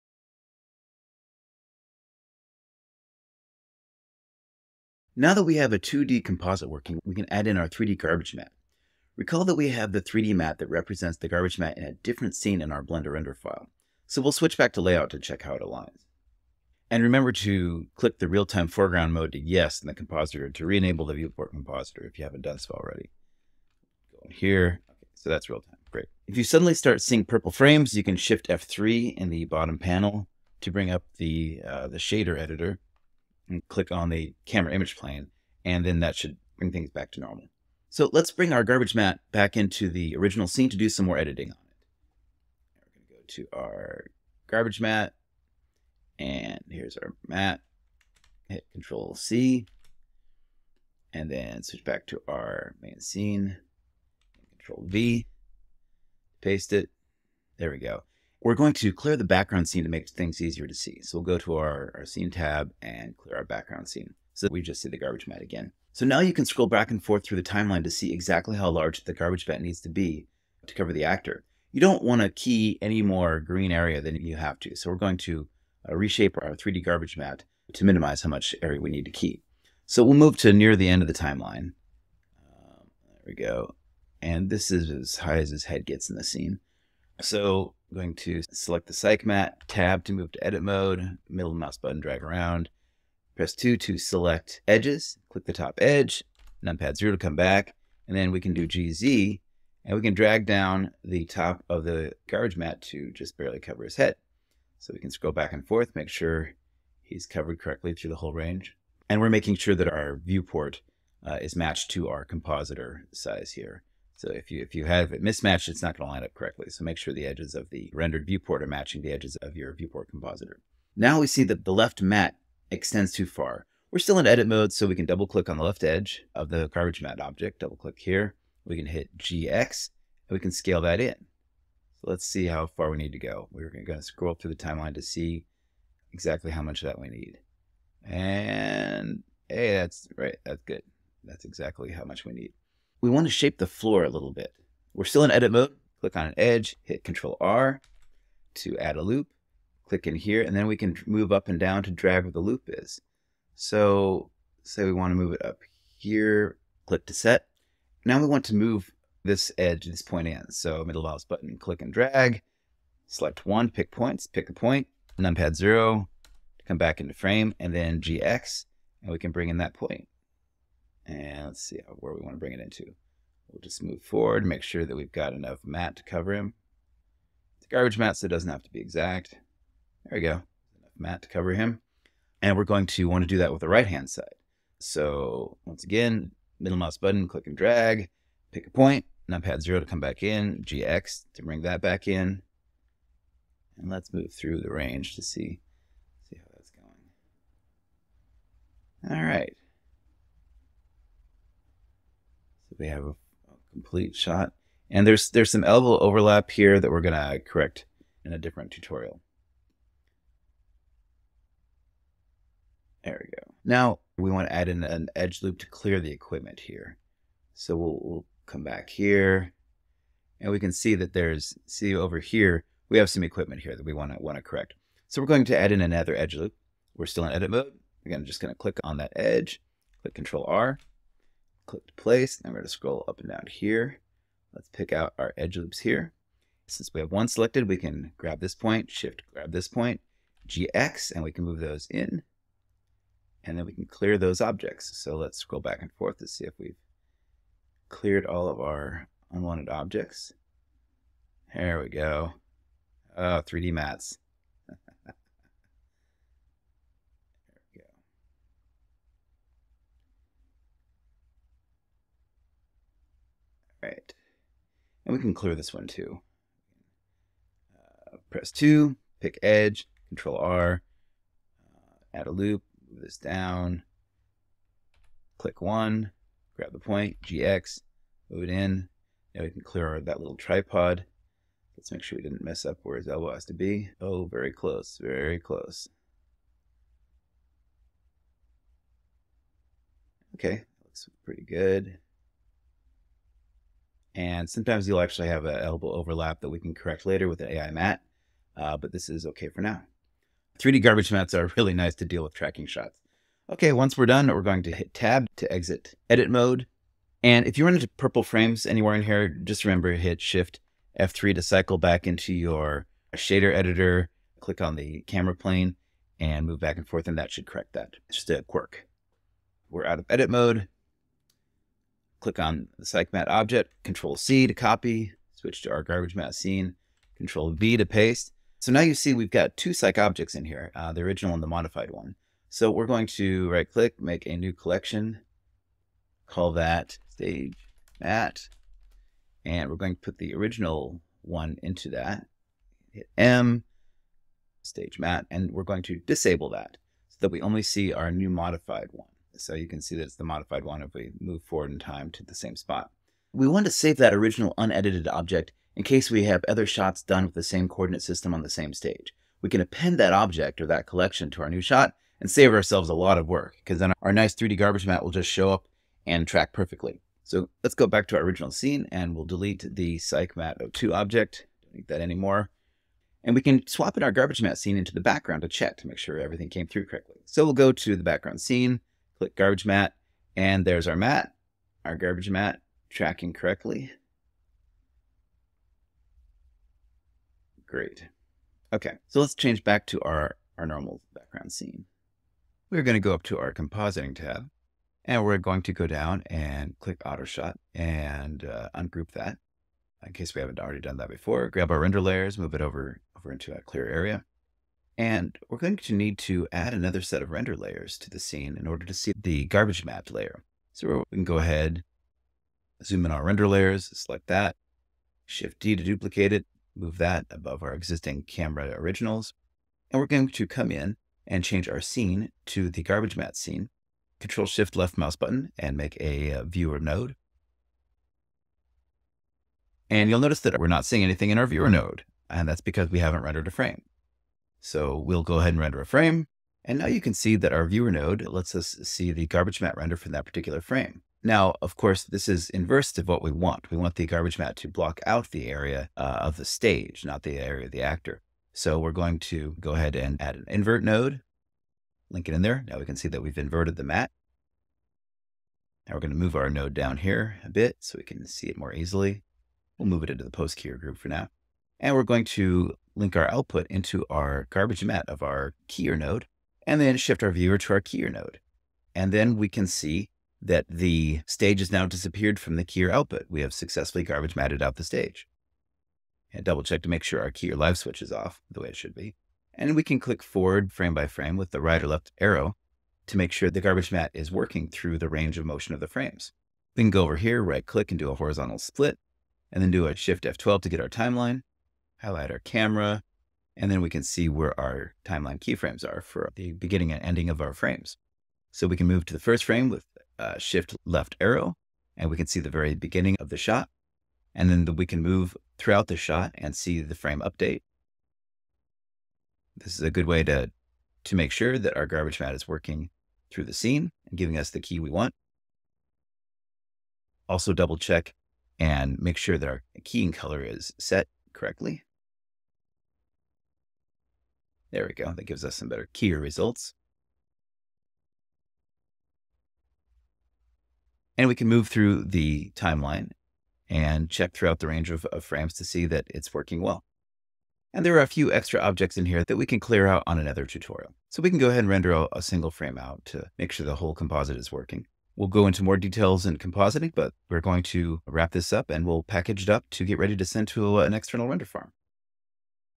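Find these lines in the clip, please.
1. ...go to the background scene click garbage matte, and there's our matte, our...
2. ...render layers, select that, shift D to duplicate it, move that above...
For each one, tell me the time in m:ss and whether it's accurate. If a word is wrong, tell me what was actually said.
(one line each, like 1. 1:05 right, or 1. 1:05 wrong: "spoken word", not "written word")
1. 6:17 right
2. 6:53 right.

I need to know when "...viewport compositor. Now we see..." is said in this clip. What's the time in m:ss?
1:59.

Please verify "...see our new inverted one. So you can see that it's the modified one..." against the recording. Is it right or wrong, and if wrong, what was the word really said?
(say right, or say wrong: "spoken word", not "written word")
wrong: "modified", not "inverted".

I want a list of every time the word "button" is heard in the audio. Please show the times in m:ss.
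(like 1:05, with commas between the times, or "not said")
1:31, 2:41, 3:06, 7:05.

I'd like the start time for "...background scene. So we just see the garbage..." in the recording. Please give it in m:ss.
1:03.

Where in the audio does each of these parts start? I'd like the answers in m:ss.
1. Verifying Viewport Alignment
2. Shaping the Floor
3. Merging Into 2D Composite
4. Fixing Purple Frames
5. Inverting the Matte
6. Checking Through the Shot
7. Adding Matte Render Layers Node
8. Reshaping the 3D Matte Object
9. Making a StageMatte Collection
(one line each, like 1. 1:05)
1. 1:48
2. 2:22
3. 6:32
4. 0:26
5. 7:21
6. 4:41
7. 6:44
8. 1:11
9. 5:19.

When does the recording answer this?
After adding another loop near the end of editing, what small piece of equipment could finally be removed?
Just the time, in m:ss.
4:40.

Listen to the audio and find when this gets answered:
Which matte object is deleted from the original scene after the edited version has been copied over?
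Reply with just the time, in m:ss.
6:09.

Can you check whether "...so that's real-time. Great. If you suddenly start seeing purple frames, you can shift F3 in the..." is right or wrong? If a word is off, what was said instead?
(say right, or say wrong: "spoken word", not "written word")
right.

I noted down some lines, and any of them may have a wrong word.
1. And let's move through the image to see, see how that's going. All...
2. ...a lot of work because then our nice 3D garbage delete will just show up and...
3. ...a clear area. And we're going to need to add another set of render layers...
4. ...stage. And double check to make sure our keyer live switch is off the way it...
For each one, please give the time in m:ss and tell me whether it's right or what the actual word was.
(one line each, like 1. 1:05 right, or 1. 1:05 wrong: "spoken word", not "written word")
1. 3:13 wrong: "range", not "image"
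2. 6:02 wrong: "matte", not "delete"
3. 6:43 right
4. 7:54 right.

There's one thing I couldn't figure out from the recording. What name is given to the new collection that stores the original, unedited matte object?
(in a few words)
stage mat.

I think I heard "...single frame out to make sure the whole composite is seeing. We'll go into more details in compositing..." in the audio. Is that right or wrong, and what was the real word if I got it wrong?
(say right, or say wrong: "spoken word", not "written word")
wrong: "working", not "seeing".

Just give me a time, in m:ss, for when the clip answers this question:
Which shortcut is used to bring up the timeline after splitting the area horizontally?
8:09.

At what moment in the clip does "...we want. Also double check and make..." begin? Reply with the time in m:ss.
8:34.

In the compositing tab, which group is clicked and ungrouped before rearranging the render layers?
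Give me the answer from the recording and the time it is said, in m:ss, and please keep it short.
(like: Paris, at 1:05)
Autoshot, at 6:37.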